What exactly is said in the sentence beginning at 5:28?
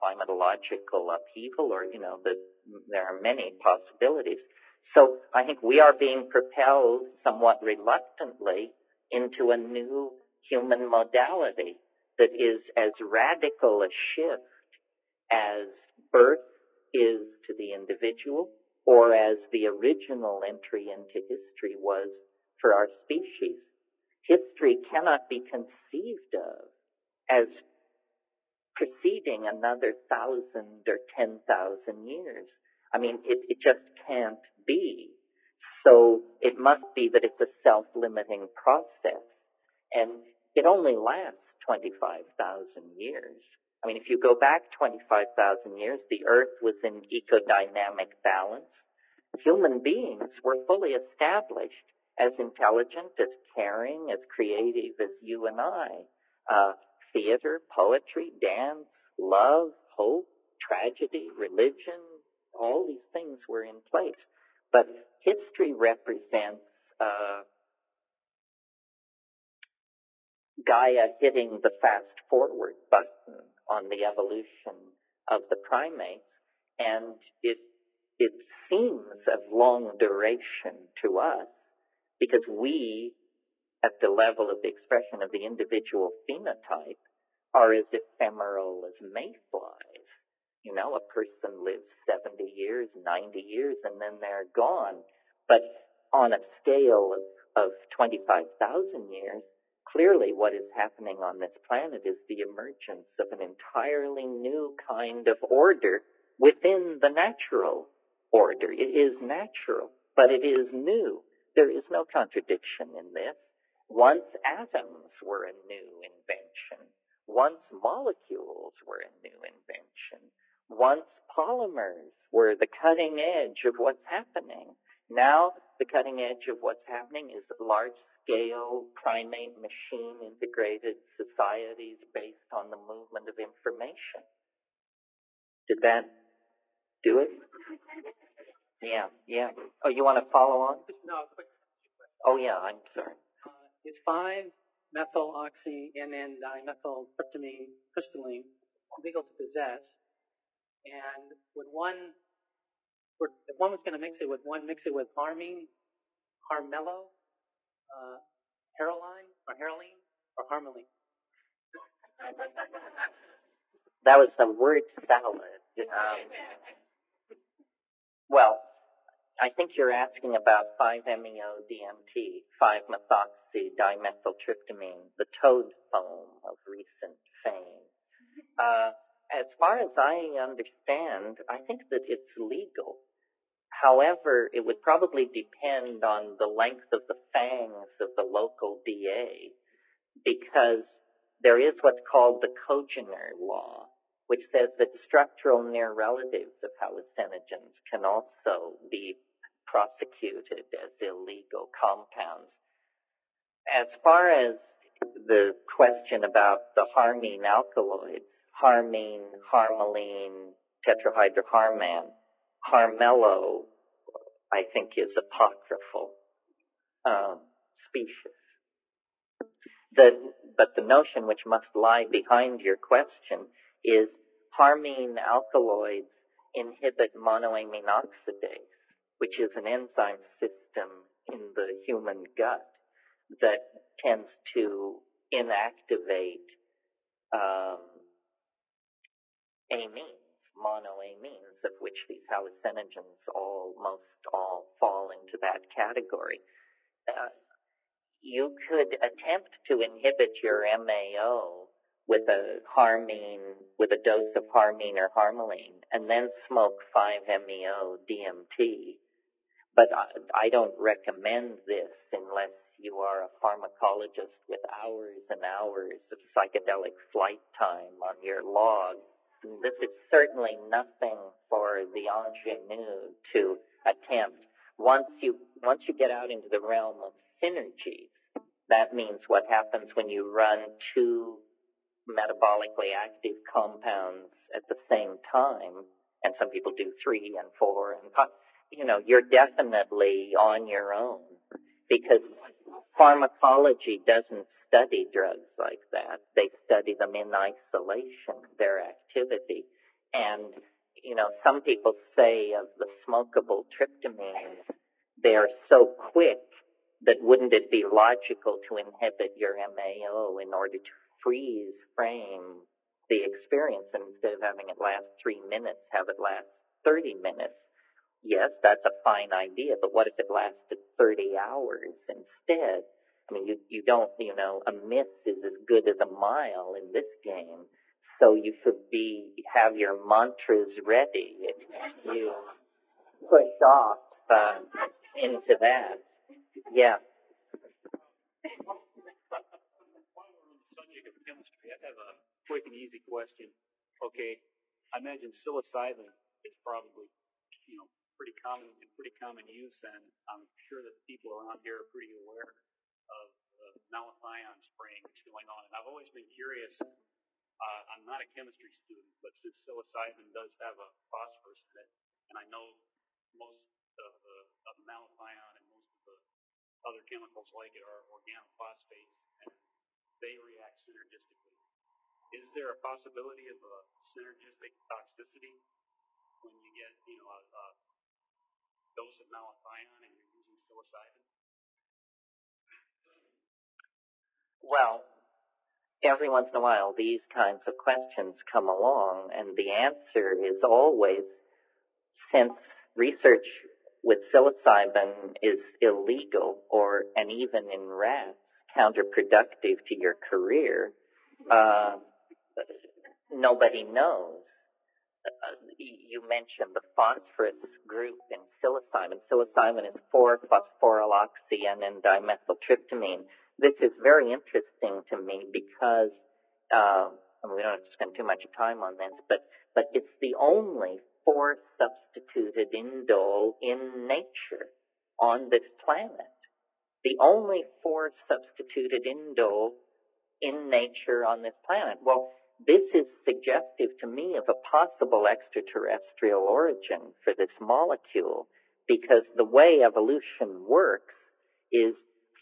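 So you should be, have your mantras ready.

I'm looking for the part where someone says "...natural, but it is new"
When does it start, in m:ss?
1:49.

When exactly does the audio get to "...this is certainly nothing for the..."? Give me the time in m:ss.
4:29.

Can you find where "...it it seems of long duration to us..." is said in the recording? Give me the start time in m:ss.
1:17.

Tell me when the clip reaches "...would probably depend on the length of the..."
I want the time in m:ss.
3:04.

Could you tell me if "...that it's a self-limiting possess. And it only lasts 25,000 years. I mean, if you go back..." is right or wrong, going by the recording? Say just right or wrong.
wrong.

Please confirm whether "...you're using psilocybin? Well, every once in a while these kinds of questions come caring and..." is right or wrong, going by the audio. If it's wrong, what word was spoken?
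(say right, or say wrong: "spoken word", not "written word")
wrong: "along", not "caring".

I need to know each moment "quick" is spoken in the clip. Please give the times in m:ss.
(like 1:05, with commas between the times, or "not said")
2:21, 5:05, 5:42.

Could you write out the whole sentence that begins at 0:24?
History cannot be conceived of as preceding another thousand or ten thousand years.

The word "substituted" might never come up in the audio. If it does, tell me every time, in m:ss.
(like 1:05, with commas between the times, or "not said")
7:01, 7:08.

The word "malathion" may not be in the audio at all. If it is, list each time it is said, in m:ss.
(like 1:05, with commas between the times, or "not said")
5:53, 6:04, 6:19.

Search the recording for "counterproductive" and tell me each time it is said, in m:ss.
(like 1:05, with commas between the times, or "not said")
6:38.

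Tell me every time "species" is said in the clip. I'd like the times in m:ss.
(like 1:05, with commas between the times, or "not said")
0:22, 3:37.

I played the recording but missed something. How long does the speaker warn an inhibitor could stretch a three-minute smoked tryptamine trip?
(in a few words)
30 hours.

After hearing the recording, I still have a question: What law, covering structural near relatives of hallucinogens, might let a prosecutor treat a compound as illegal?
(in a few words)
congener law.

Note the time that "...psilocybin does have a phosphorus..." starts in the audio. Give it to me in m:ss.
5:59.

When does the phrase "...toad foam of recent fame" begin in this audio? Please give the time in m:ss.
2:55.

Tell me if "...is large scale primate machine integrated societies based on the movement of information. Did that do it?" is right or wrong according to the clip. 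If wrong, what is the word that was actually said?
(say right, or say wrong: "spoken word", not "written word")
right.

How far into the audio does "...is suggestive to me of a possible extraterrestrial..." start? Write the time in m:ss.
7:12.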